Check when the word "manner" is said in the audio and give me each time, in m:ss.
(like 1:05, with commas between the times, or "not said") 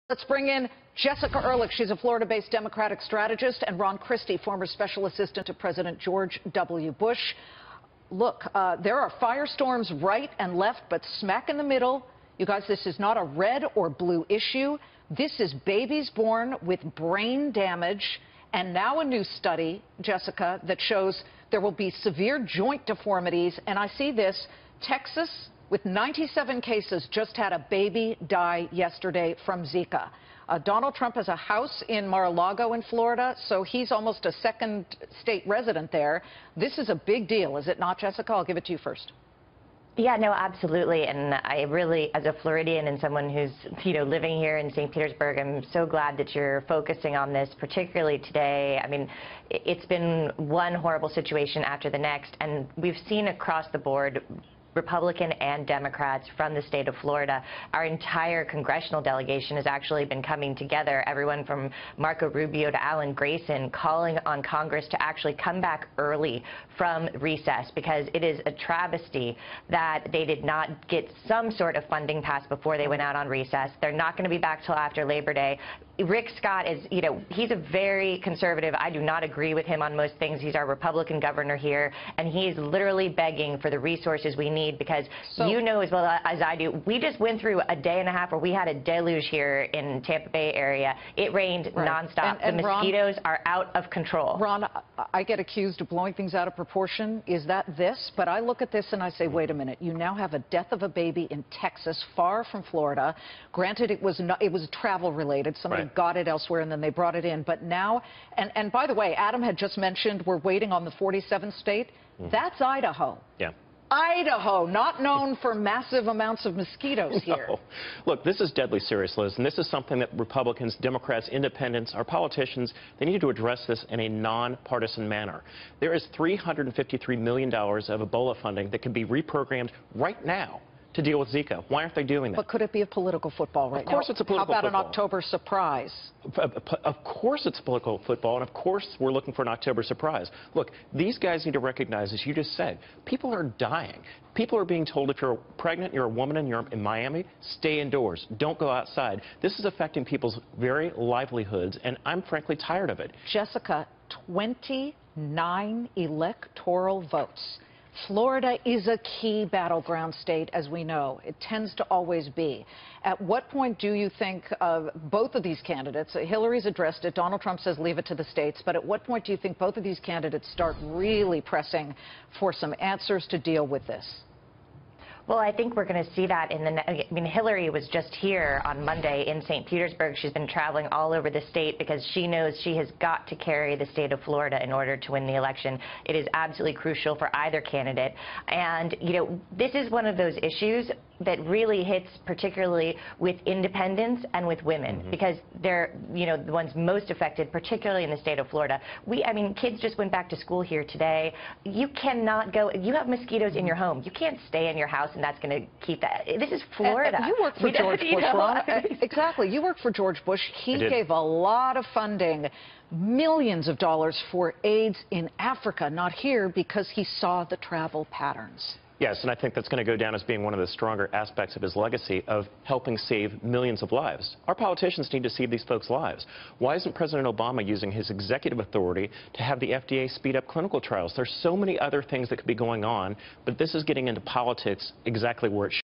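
2:05.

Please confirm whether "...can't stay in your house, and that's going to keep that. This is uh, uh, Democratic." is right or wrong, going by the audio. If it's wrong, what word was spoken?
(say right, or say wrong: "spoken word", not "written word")
wrong: "Florida", not "Democratic".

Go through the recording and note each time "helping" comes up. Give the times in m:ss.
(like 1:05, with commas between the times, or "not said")
3:42.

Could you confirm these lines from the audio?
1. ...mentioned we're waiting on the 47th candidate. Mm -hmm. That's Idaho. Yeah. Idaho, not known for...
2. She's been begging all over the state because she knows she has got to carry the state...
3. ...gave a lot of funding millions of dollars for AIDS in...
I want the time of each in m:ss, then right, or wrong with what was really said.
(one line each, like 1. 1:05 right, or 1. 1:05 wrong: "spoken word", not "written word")
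1. 1:49 wrong: "state", not "candidate"
2. 3:00 wrong: "traveling", not "begging"
3. 3:30 right.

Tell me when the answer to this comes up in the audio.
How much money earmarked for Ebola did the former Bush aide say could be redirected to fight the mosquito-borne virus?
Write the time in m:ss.
2:06.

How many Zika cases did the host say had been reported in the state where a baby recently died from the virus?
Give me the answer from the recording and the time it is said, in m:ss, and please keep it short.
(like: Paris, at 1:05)
97, at 0:25.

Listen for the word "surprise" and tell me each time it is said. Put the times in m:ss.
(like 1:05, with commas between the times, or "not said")
2:15, 2:19.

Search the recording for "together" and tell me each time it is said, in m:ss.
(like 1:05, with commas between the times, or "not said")
1:00.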